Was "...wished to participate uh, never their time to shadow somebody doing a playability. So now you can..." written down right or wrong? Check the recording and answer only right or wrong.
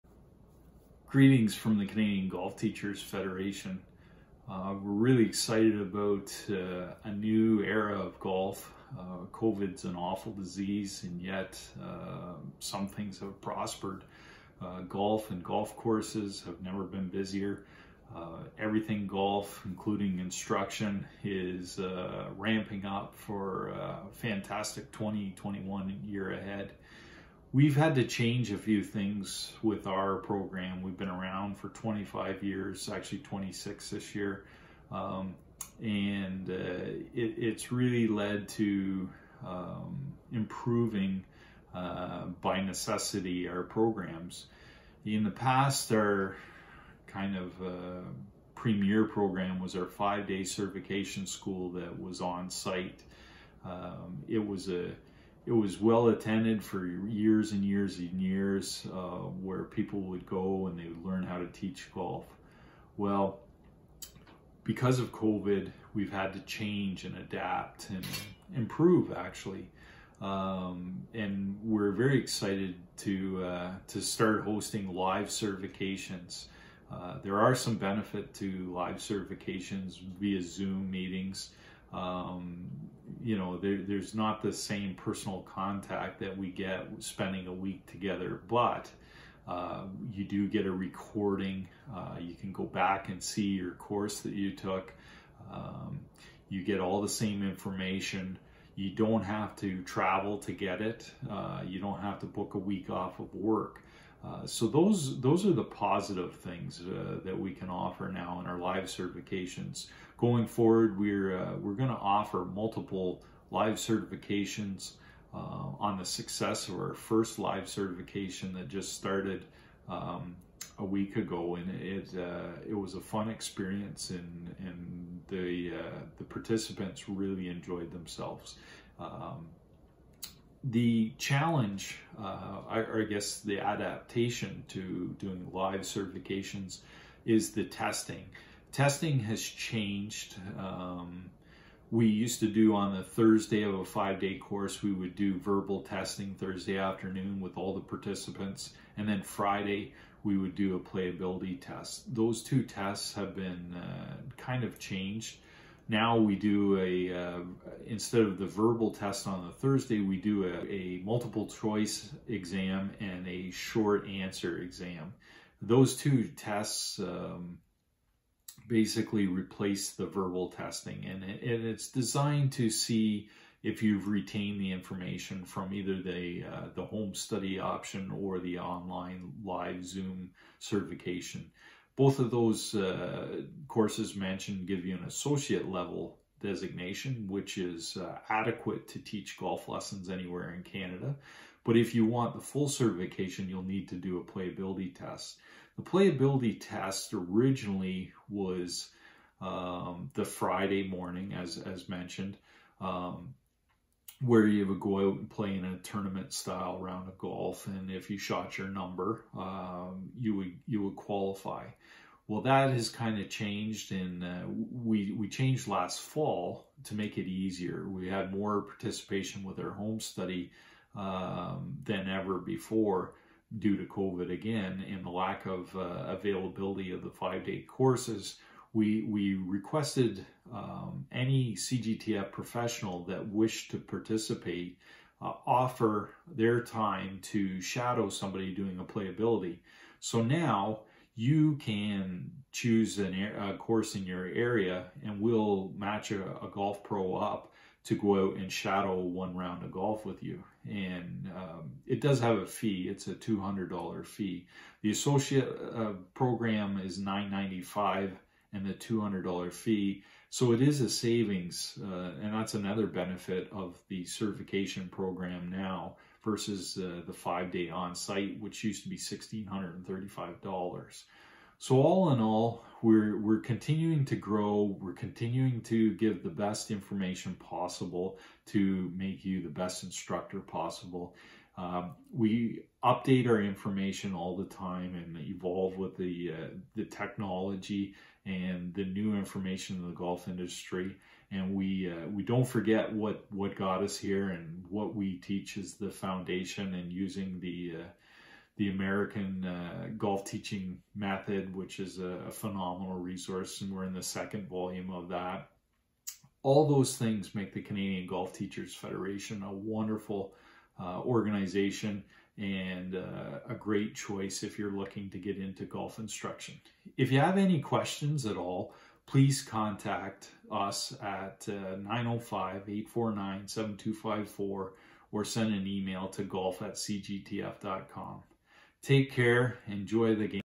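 wrong.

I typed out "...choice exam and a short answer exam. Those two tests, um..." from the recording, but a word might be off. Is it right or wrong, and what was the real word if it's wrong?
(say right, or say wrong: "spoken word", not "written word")
right.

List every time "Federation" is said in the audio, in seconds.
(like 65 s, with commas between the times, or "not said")
3 s, 308 s.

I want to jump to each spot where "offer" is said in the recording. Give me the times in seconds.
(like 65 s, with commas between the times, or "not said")
107 s, 111 s, 235 s.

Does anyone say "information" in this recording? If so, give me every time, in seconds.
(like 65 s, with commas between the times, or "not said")
97 s, 174 s, 276 s, 283 s, 289 s.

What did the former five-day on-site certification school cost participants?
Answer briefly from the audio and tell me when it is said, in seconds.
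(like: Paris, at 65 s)
$1,635, at 268 s.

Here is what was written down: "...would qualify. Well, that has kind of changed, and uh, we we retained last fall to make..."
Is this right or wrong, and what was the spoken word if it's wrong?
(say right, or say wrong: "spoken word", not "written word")
wrong: "changed", not "retained".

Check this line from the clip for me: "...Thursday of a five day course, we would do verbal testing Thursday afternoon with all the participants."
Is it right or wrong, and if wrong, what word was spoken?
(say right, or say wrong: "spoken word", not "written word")
right.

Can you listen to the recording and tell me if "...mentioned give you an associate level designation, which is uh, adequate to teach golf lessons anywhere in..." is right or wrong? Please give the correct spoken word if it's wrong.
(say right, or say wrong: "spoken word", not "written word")
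right.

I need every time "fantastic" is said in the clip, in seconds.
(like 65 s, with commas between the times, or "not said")
24 s.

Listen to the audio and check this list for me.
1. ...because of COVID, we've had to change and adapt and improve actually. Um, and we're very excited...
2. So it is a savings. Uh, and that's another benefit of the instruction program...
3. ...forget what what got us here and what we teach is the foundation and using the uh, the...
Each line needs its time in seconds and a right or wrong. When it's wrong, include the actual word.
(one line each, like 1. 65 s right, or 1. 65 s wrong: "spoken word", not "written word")
1. 64 s right
2. 260 s wrong: "certification", not "instruction"
3. 292 s right.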